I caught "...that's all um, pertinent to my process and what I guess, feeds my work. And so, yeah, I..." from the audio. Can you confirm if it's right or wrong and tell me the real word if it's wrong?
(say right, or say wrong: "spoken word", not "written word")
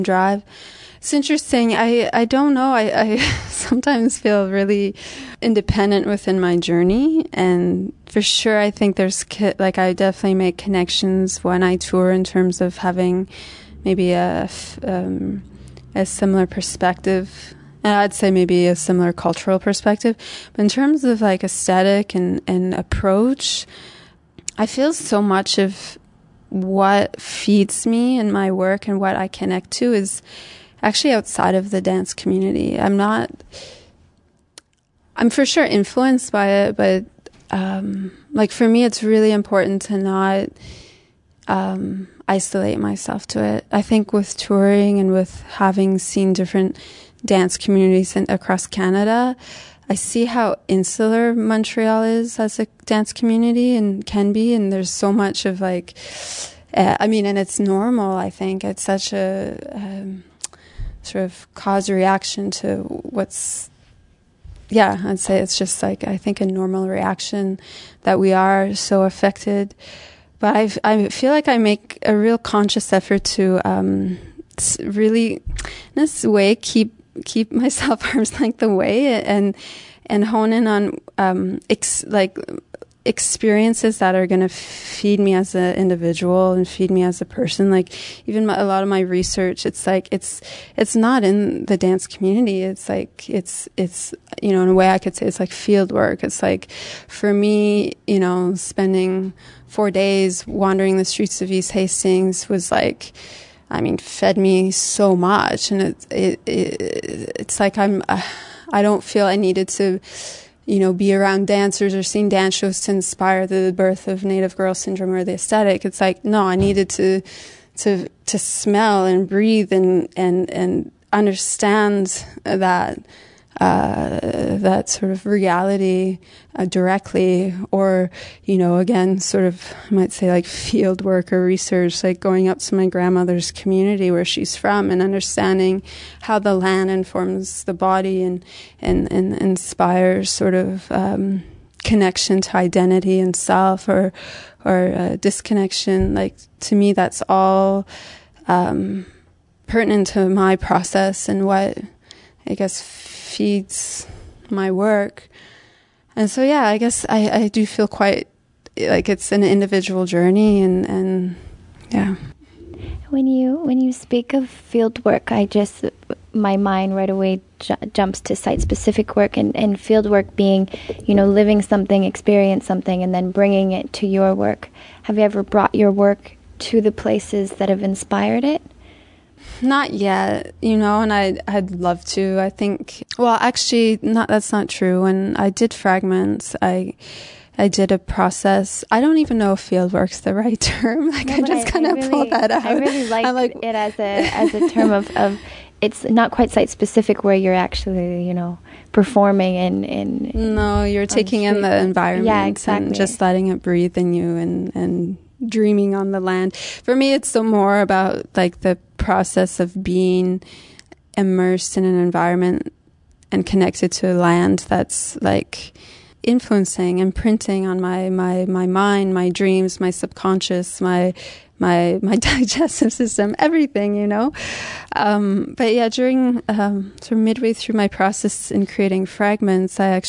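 right.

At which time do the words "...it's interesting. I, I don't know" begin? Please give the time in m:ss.
0:01.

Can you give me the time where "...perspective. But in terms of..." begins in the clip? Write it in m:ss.
0:19.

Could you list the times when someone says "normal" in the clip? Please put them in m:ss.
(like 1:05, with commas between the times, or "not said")
0:57, 1:06.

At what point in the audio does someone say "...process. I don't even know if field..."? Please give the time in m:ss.
3:07.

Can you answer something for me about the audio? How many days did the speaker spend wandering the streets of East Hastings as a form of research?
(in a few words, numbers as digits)
4.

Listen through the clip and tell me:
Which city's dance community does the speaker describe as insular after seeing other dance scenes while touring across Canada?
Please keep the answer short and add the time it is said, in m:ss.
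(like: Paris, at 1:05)
Montreal, at 0:51.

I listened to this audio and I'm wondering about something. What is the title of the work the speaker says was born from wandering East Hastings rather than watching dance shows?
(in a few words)
Native Girl Syndrome.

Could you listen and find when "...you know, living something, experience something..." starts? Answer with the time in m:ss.
2:51.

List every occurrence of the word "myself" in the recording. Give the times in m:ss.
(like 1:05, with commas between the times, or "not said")
0:42, 1:17.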